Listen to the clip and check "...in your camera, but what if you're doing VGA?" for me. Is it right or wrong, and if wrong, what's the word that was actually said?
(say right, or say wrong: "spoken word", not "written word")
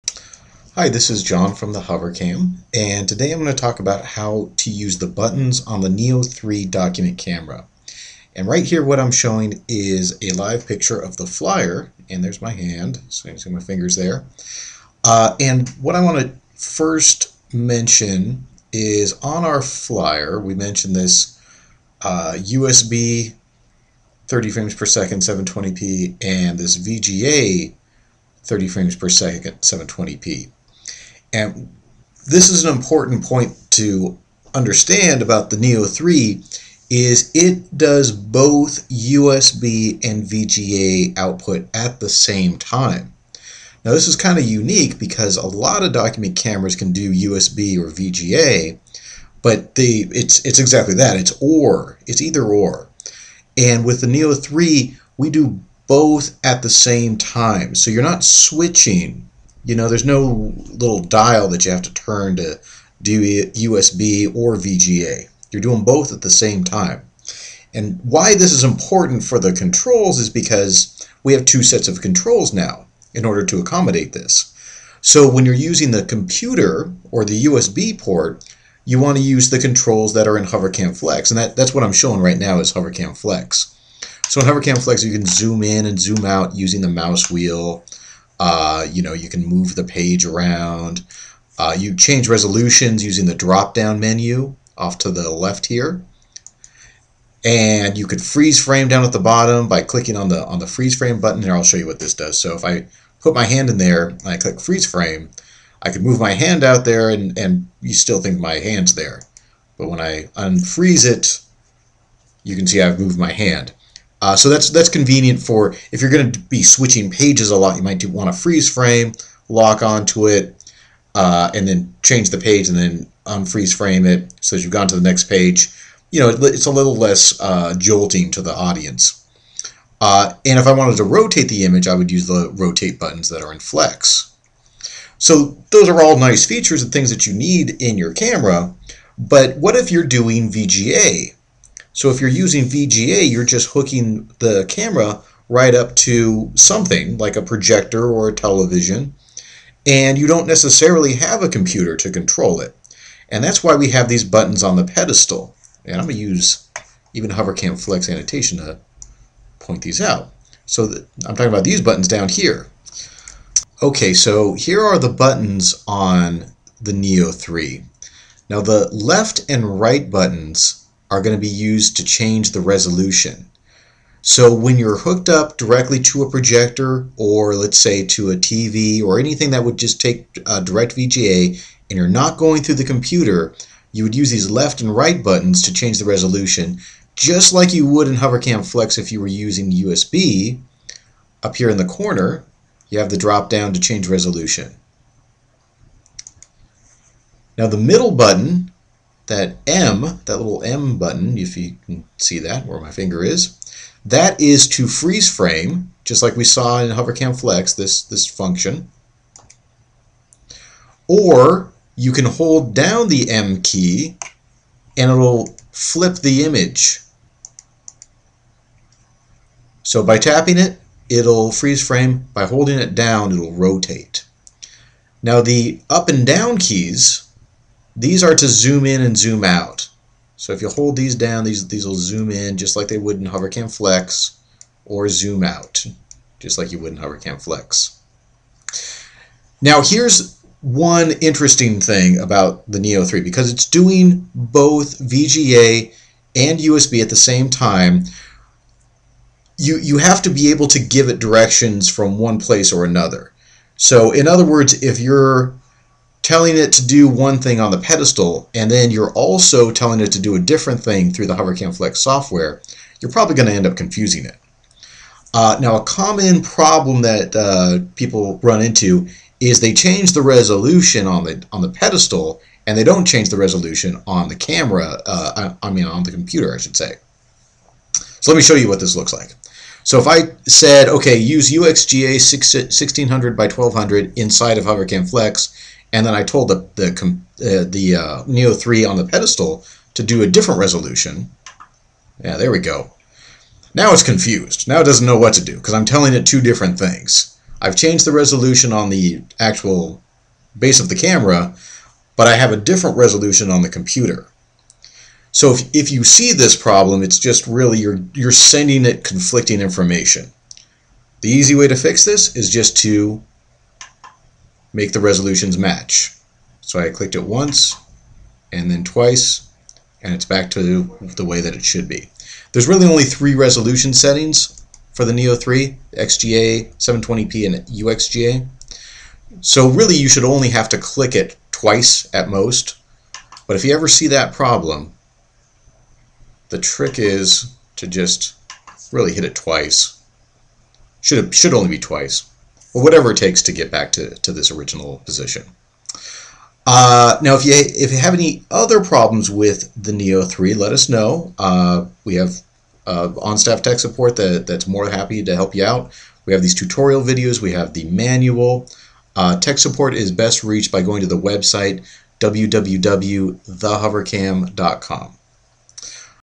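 right.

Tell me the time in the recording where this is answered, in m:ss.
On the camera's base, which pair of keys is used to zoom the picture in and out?
3:45.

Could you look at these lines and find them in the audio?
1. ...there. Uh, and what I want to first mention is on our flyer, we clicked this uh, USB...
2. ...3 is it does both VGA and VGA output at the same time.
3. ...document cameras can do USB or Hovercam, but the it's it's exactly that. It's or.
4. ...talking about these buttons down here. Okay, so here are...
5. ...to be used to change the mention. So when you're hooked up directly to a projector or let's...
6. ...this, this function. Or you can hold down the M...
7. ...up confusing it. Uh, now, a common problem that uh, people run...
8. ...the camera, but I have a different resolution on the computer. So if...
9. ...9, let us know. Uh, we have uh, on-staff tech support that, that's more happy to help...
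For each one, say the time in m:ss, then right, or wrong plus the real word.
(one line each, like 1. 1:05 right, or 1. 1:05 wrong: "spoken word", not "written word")
1. 0:13 wrong: "mentioned", not "clicked"
2. 0:35 wrong: "USB", not "VGA"
3. 0:45 wrong: "VGA", not "Hovercam"
4. 2:41 right
5. 2:51 wrong: "resolution", not "mention"
6. 3:27 right
7. 4:23 right
8. 5:00 right
9. 5:50 wrong: "3", not "9".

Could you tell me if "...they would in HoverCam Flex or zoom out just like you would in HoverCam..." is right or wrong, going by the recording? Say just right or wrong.
right.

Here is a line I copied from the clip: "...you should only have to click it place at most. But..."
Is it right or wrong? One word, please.
wrong.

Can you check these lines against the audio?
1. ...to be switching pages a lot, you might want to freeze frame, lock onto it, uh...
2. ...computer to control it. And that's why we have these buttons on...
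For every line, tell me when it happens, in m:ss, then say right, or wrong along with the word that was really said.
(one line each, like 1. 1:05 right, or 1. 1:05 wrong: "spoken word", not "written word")
1. 1:56 right
2. 2:31 right.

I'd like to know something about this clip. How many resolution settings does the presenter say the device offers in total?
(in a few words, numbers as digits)
3.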